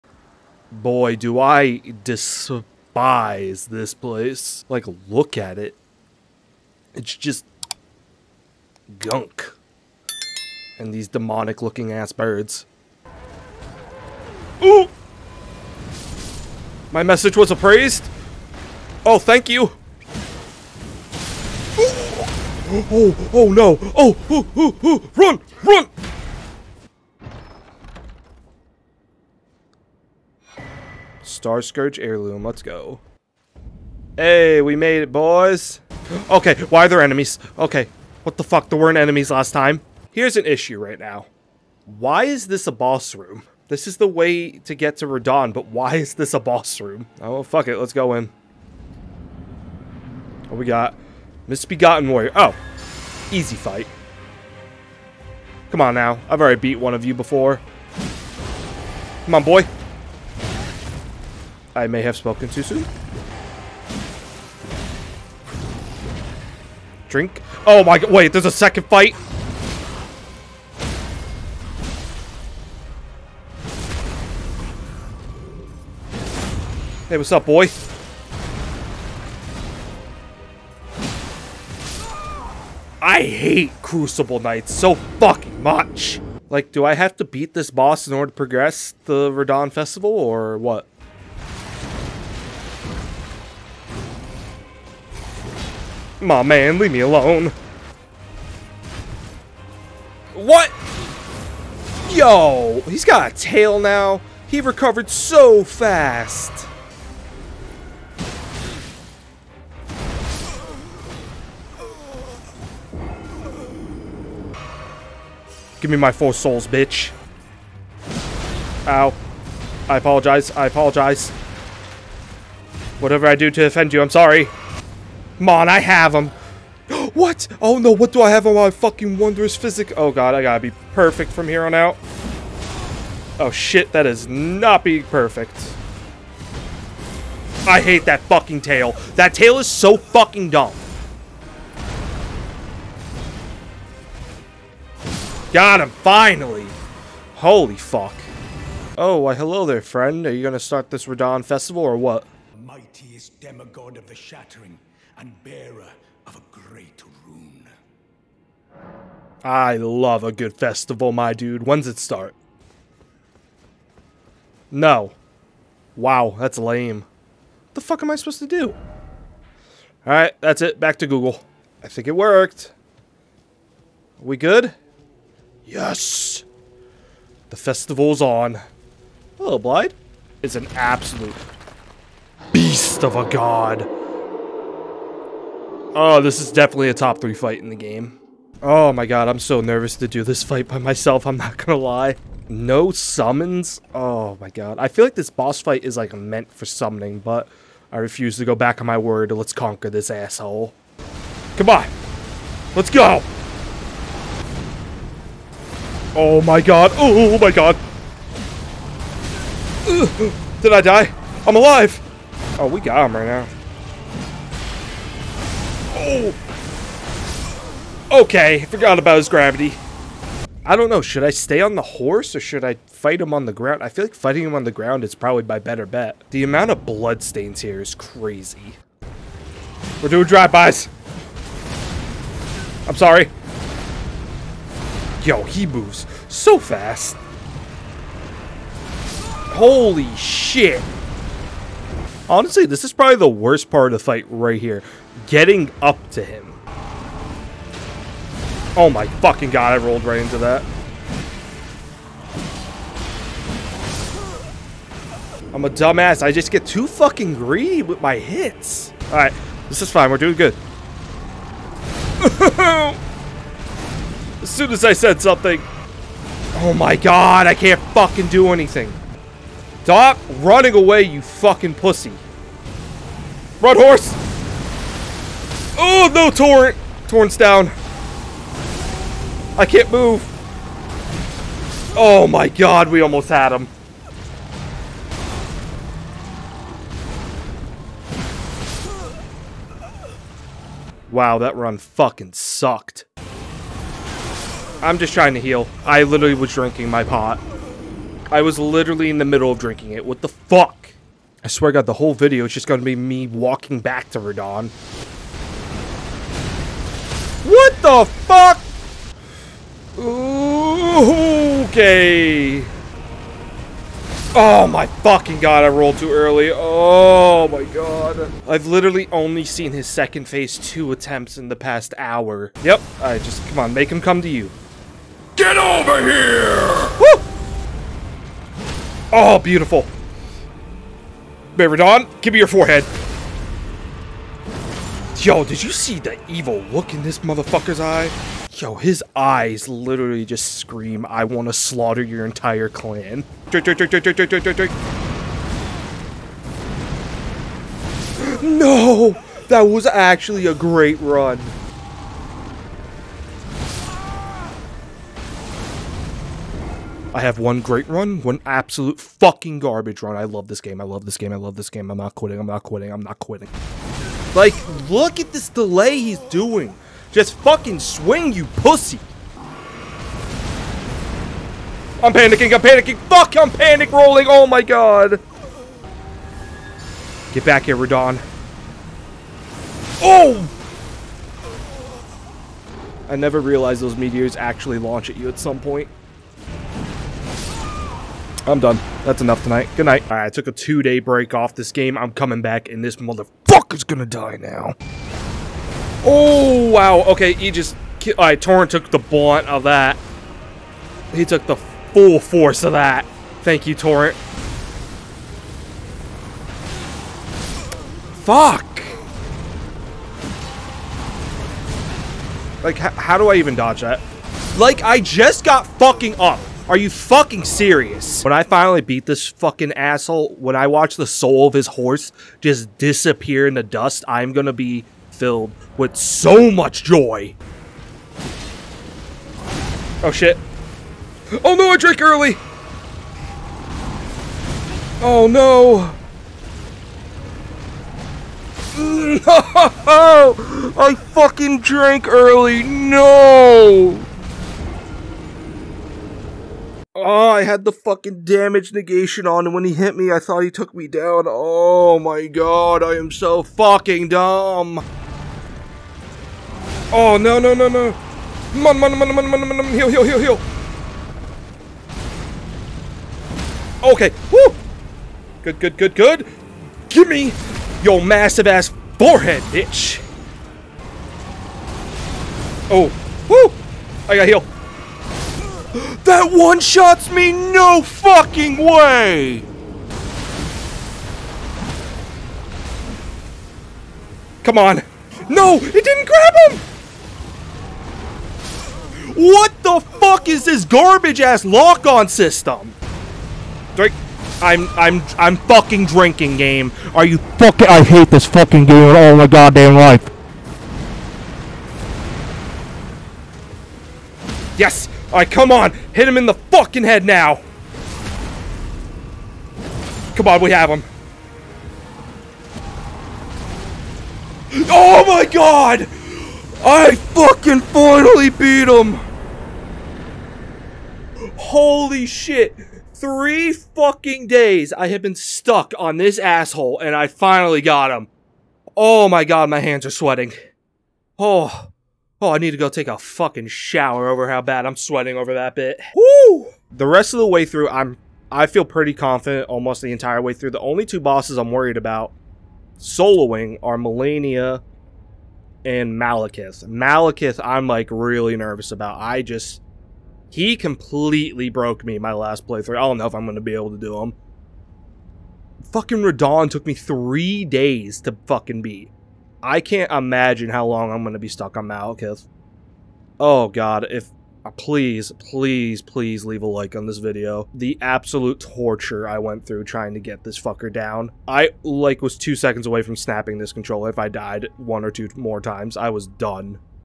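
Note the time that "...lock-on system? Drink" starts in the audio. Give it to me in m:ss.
8:11.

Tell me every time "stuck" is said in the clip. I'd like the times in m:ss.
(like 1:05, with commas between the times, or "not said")
8:45, 9:21.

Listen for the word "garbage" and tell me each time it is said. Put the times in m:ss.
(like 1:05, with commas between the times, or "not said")
5:59, 8:10.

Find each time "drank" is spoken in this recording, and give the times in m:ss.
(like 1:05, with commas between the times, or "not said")
7:11, 7:21.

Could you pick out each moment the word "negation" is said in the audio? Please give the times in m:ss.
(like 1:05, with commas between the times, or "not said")
7:28.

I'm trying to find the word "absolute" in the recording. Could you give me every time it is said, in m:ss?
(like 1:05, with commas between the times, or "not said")
3:00, 5:58, 9:27.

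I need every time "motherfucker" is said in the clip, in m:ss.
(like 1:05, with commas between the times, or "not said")
5:37, 6:32.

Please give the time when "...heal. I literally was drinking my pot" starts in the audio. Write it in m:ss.
4:55.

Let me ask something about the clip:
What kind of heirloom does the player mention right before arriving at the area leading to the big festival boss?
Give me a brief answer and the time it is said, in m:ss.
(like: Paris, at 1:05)
Star Scourge heirloom, at 0:31.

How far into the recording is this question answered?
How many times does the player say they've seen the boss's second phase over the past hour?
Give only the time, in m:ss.
5:20.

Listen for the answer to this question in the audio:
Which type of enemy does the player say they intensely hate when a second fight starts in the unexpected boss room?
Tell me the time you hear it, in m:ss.
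1:23.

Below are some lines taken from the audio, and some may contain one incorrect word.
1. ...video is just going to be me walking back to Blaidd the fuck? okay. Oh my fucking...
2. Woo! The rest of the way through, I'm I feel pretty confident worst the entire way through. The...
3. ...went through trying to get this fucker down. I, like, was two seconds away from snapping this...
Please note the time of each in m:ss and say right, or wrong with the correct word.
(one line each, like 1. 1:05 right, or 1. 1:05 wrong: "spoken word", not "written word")
1. 5:02 wrong: "Radahn", not "Blaidd"
2. 8:55 wrong: "almost", not "worst"
3. 9:29 right.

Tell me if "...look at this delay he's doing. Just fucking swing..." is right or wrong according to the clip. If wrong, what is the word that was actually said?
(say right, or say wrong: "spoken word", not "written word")
right.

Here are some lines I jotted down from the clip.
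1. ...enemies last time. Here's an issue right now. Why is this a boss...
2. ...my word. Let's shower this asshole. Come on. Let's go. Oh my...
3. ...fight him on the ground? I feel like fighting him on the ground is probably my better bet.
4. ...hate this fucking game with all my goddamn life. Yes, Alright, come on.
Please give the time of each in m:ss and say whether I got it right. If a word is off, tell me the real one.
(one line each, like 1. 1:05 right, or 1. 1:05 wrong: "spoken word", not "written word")
1. 0:38 right
2. 3:18 wrong: "conquer", not "shower"
3. 3:42 right
4. 8:17 right.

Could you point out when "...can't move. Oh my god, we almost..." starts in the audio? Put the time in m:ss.
4:39.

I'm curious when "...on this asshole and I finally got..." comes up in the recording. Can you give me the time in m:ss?
8:45.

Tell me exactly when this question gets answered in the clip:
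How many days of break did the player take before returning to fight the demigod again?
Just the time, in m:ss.
6:30.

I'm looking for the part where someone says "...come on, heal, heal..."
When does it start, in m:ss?
7:39.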